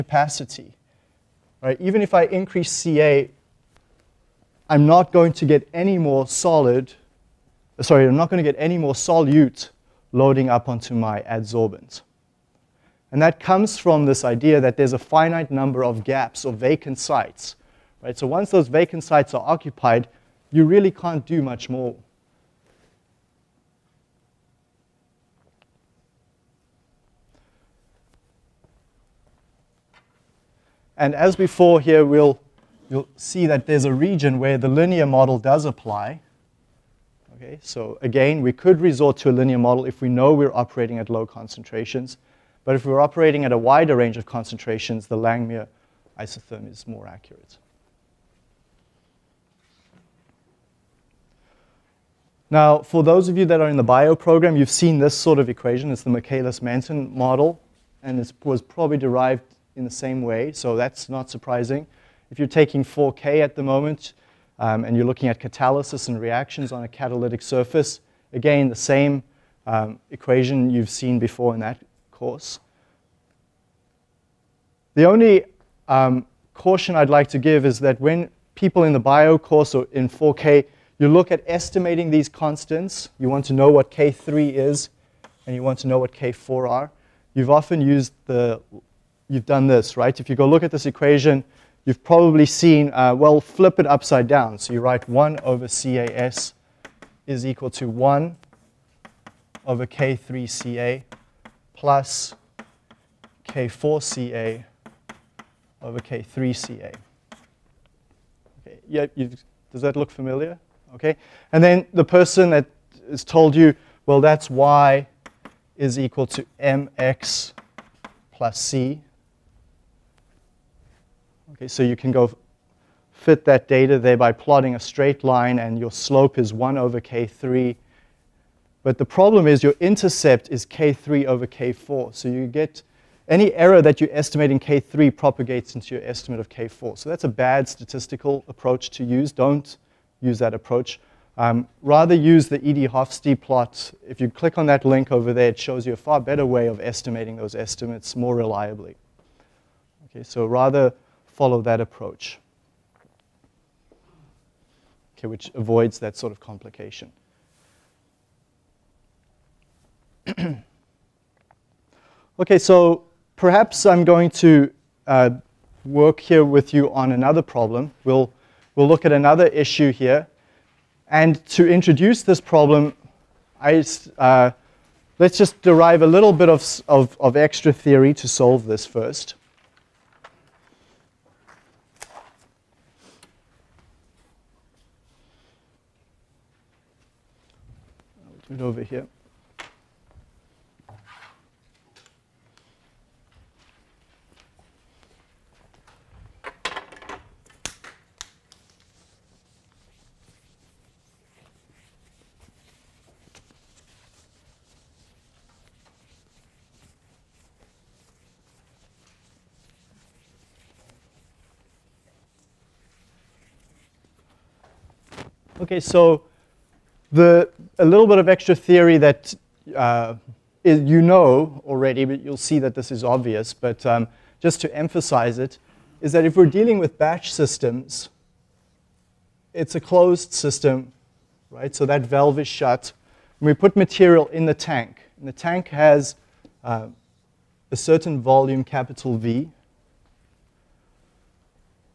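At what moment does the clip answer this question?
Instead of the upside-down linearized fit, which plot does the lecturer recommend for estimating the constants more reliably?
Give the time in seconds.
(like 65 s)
142 s.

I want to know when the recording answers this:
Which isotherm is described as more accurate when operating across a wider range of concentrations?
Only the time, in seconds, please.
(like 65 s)
45 s.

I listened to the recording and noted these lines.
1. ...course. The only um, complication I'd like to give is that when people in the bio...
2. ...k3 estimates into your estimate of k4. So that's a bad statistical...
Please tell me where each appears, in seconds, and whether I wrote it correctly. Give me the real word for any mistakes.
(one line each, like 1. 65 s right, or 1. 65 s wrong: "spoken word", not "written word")
1. 72 s wrong: "caution", not "complication"
2. 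134 s wrong: "propagates", not "estimates".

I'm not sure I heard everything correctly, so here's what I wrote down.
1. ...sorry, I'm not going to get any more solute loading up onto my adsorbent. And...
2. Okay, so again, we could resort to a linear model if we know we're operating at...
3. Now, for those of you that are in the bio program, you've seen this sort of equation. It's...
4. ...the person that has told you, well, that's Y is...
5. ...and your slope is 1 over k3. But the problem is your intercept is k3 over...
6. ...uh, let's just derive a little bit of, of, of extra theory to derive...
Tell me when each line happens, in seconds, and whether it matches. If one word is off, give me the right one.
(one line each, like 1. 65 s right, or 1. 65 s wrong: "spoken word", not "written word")
1. 7 s right
2. 37 s right
3. 52 s right
4. 111 s right
5. 125 s right
6. 174 s wrong: "solve", not "derive".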